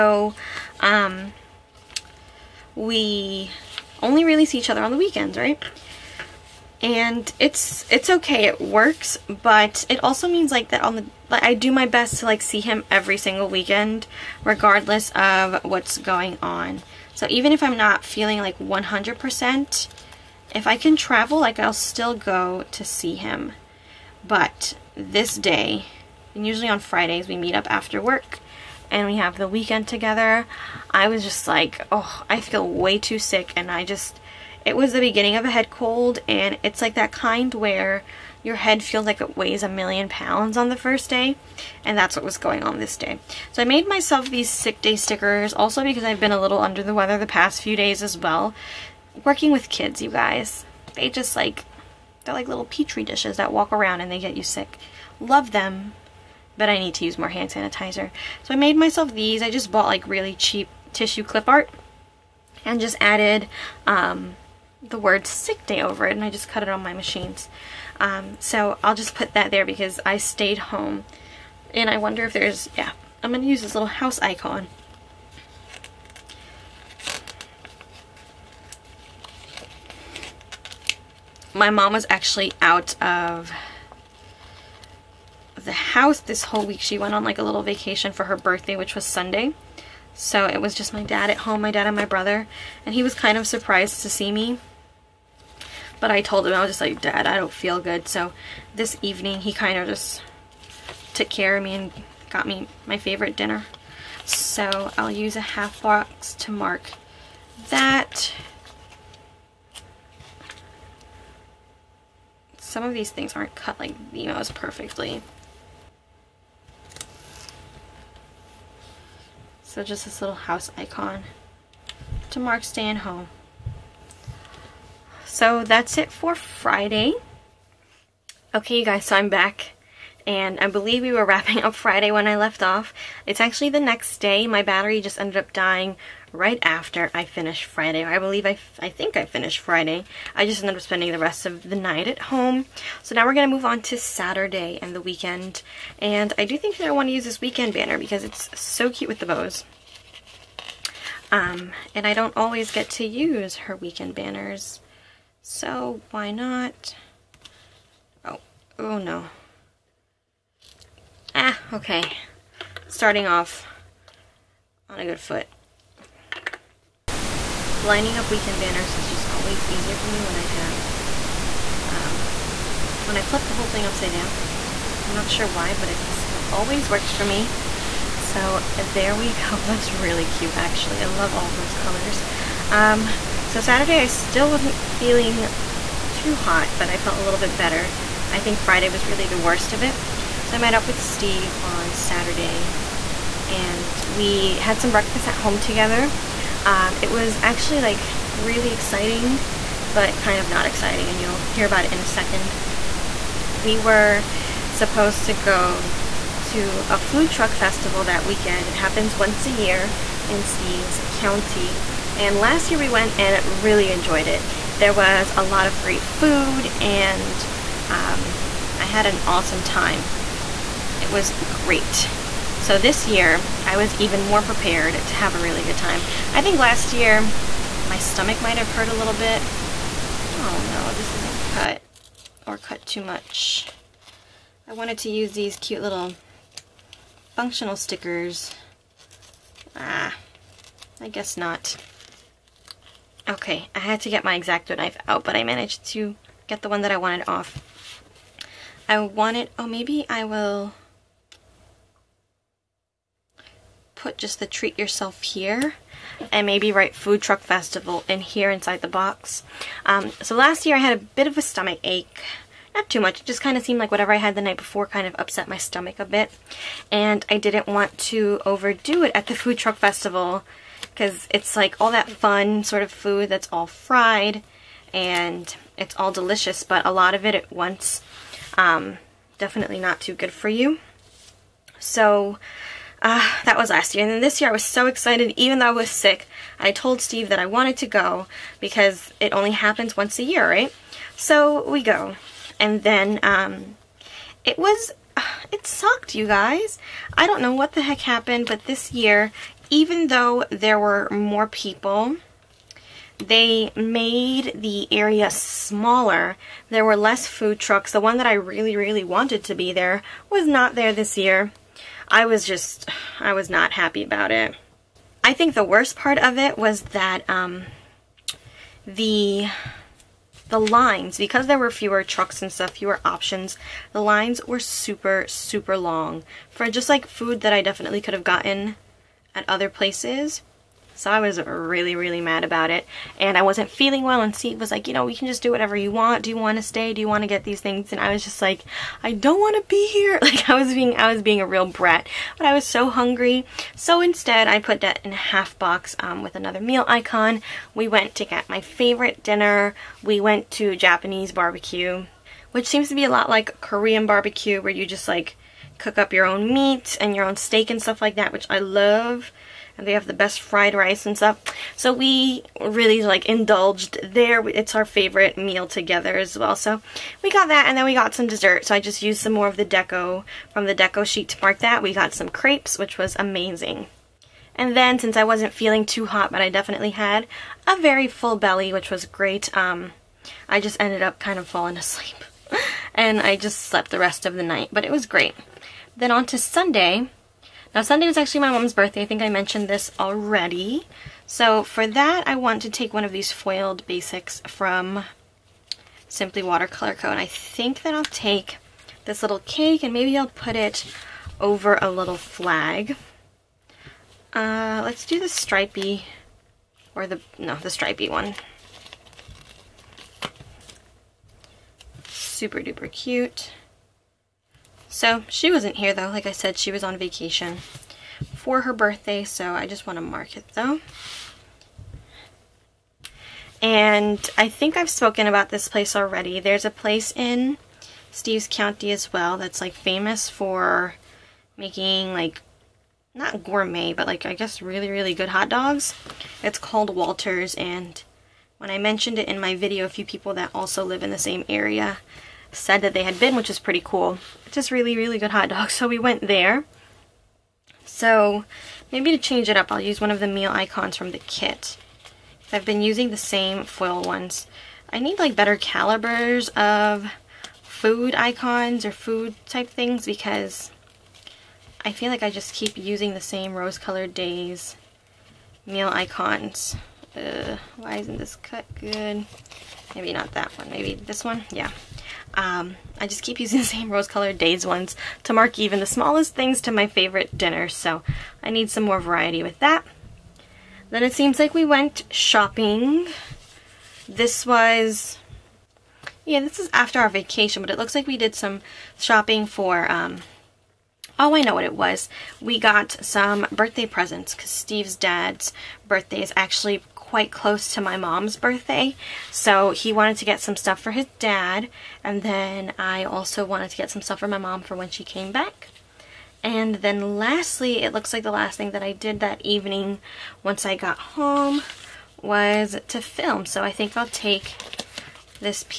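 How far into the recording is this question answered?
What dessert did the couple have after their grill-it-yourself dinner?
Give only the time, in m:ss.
6:12.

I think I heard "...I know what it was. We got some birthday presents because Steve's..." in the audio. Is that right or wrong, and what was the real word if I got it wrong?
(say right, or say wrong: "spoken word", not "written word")
right.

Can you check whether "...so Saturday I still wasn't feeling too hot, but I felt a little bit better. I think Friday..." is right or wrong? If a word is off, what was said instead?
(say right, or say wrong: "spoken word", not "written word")
right.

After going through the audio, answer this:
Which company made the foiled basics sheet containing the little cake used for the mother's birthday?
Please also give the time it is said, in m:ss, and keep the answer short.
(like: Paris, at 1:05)
Simply Watercolor Co., at 6:36.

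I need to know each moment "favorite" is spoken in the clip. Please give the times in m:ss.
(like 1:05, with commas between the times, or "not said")
1:42, 5:48, 6:04, 7:56.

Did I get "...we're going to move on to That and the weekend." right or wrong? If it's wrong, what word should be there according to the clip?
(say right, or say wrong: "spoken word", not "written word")
wrong: "Saturday", not "That".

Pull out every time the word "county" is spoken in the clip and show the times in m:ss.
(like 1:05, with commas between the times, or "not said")
3:31, 7:08.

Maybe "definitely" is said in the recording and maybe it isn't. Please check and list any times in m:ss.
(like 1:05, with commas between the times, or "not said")
4:39, 5:27, 6:16.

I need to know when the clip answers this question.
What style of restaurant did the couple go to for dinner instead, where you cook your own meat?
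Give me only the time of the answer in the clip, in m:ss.
5:50.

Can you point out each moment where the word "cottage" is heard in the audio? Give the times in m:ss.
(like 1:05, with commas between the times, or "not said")
not said.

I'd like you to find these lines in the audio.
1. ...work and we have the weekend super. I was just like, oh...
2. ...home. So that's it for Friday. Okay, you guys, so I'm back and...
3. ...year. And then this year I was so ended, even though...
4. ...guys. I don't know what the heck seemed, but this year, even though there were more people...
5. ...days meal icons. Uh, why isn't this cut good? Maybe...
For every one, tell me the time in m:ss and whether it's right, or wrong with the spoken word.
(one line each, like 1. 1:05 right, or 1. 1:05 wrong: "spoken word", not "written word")
1. 0:28 wrong: "together", not "super"
2. 2:02 right
3. 4:43 wrong: "excited", not "ended"
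4. 4:56 wrong: "happened", not "seemed"
5. 7:44 right.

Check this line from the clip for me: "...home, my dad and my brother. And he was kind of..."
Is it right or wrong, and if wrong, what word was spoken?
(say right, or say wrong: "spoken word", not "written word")
right.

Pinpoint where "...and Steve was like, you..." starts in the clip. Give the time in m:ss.
5:34.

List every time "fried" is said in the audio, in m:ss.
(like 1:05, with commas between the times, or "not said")
4:33, 6:00.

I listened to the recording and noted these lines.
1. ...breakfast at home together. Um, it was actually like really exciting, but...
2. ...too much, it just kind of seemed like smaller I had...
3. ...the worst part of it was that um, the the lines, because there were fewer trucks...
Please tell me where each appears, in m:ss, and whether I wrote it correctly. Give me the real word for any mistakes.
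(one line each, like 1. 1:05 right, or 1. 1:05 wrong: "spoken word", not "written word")
1. 3:14 right
2. 4:22 wrong: "whatever", not "smaller"
3. 5:15 right.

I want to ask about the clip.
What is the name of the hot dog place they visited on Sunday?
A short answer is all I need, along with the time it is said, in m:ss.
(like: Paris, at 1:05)
Walters, at 7:16.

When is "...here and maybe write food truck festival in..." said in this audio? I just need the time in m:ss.
4:15.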